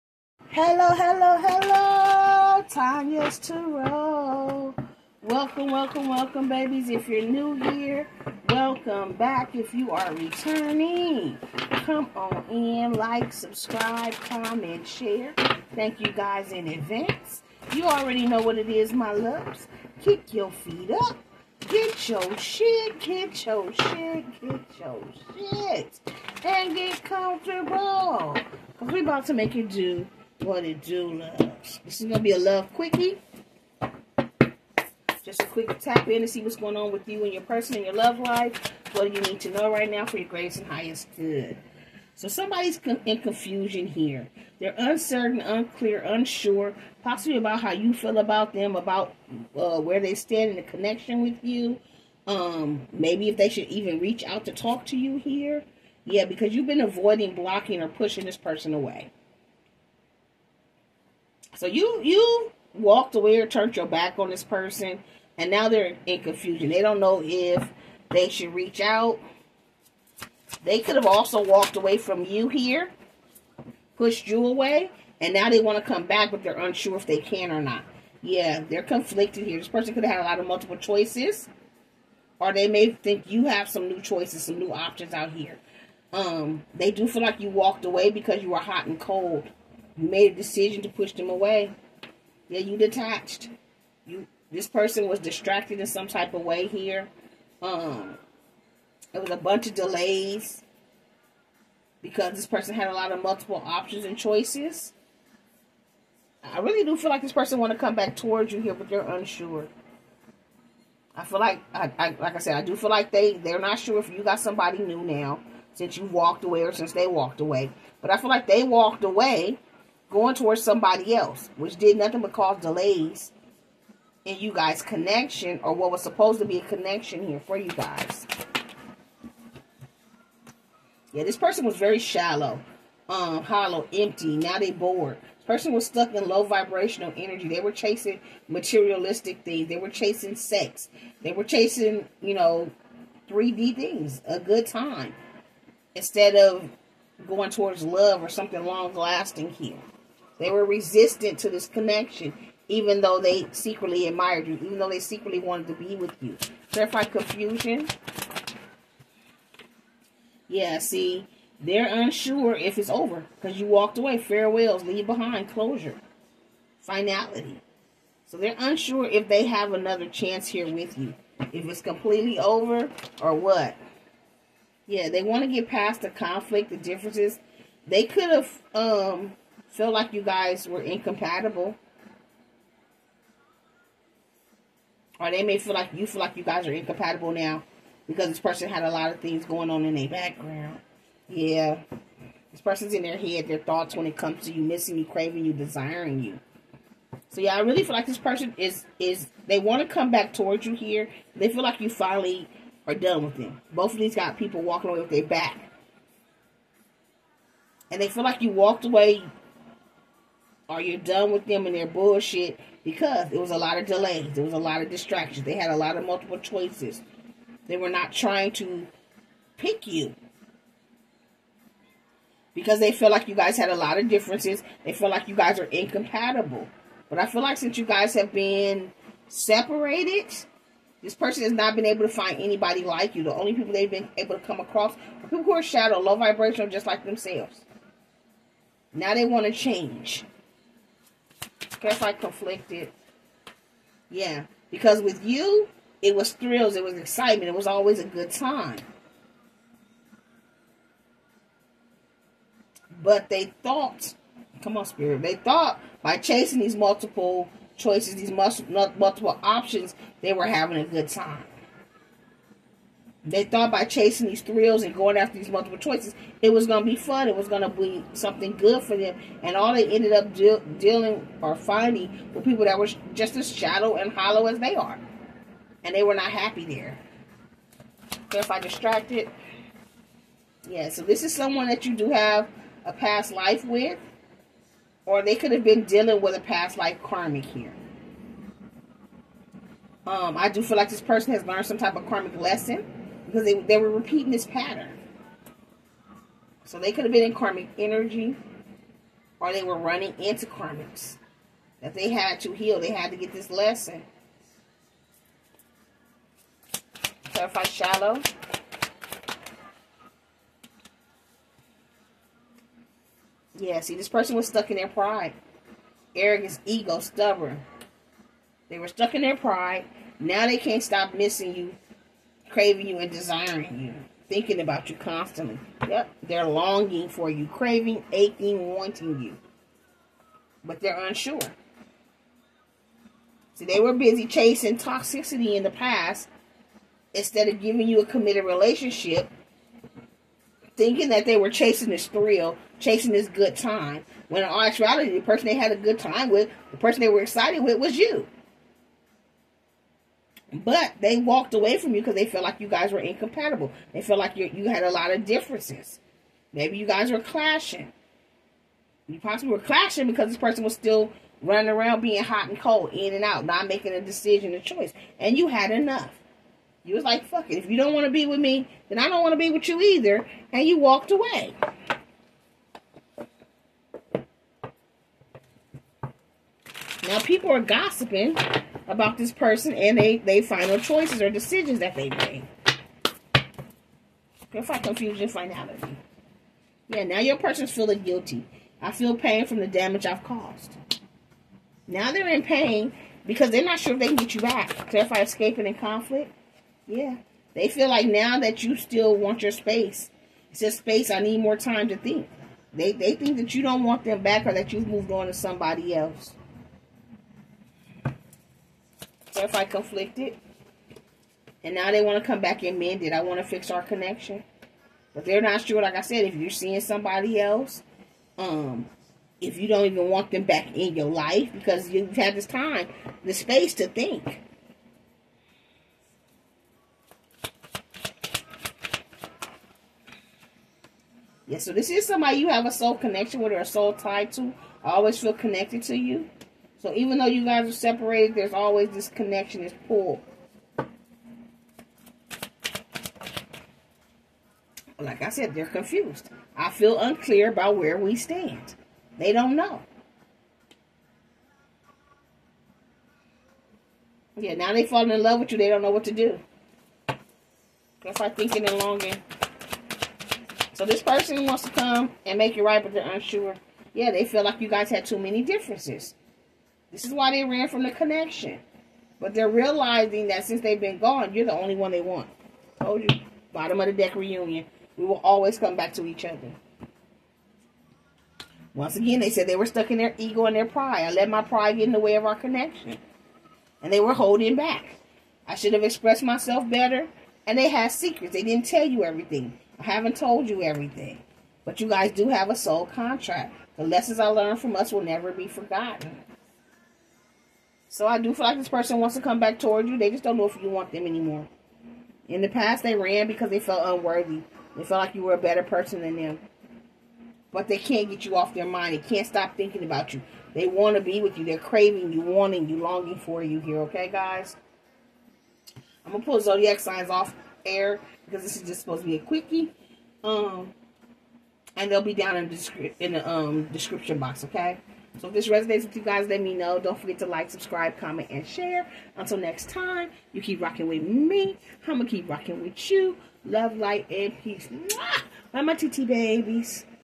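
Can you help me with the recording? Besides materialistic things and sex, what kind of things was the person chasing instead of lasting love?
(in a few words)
3D things.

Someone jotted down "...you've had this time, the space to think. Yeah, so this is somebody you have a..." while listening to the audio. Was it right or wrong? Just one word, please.
right.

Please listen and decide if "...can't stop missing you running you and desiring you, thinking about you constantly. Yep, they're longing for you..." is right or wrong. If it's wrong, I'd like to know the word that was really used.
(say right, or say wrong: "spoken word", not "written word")
wrong: "craving", not "running".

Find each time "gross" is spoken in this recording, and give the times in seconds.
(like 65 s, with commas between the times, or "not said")
not said.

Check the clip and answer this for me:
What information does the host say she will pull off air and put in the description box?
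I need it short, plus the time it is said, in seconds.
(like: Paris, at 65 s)
zodiac signs, at 516 s.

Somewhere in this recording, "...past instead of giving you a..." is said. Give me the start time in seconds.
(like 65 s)
335 s.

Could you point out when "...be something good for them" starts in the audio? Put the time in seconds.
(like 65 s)
267 s.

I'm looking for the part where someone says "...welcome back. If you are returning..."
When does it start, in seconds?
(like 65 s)
8 s.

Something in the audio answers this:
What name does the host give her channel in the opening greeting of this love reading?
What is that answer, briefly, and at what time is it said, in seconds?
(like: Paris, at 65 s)
Tanya's Tarot, at 2 s.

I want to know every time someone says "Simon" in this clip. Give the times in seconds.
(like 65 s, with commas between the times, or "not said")
not said.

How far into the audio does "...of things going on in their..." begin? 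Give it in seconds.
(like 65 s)
189 s.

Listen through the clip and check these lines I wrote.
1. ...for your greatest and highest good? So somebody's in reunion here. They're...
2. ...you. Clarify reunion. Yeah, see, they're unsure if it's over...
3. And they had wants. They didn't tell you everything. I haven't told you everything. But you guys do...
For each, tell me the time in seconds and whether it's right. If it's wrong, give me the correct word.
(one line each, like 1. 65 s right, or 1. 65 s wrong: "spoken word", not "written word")
1. 40 s wrong: "confusion", not "reunion"
2. 156 s wrong: "confusion", not "reunion"
3. 487 s wrong: "secrets", not "wants".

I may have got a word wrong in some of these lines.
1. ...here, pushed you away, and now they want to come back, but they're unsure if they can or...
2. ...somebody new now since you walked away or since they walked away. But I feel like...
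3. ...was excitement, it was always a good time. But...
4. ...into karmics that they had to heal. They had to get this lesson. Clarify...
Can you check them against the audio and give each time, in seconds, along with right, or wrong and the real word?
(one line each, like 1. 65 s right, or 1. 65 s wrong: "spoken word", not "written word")
1. 72 s right
2. 114 s right
3. 246 s right
4. 300 s right.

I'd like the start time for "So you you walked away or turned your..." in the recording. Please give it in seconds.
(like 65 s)
61 s.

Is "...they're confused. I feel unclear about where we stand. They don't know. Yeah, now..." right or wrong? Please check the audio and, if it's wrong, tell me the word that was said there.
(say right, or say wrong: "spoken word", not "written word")
right.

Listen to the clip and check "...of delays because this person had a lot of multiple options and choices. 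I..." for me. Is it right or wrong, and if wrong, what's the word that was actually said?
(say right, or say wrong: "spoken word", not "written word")
right.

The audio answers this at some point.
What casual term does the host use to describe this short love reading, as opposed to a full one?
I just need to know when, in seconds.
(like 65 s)
32 s.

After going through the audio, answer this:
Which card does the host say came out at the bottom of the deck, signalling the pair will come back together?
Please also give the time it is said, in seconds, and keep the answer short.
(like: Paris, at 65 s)
Reunion, at 473 s.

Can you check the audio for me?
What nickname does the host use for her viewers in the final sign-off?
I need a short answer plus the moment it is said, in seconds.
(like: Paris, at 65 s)
TT babies, at 535 s.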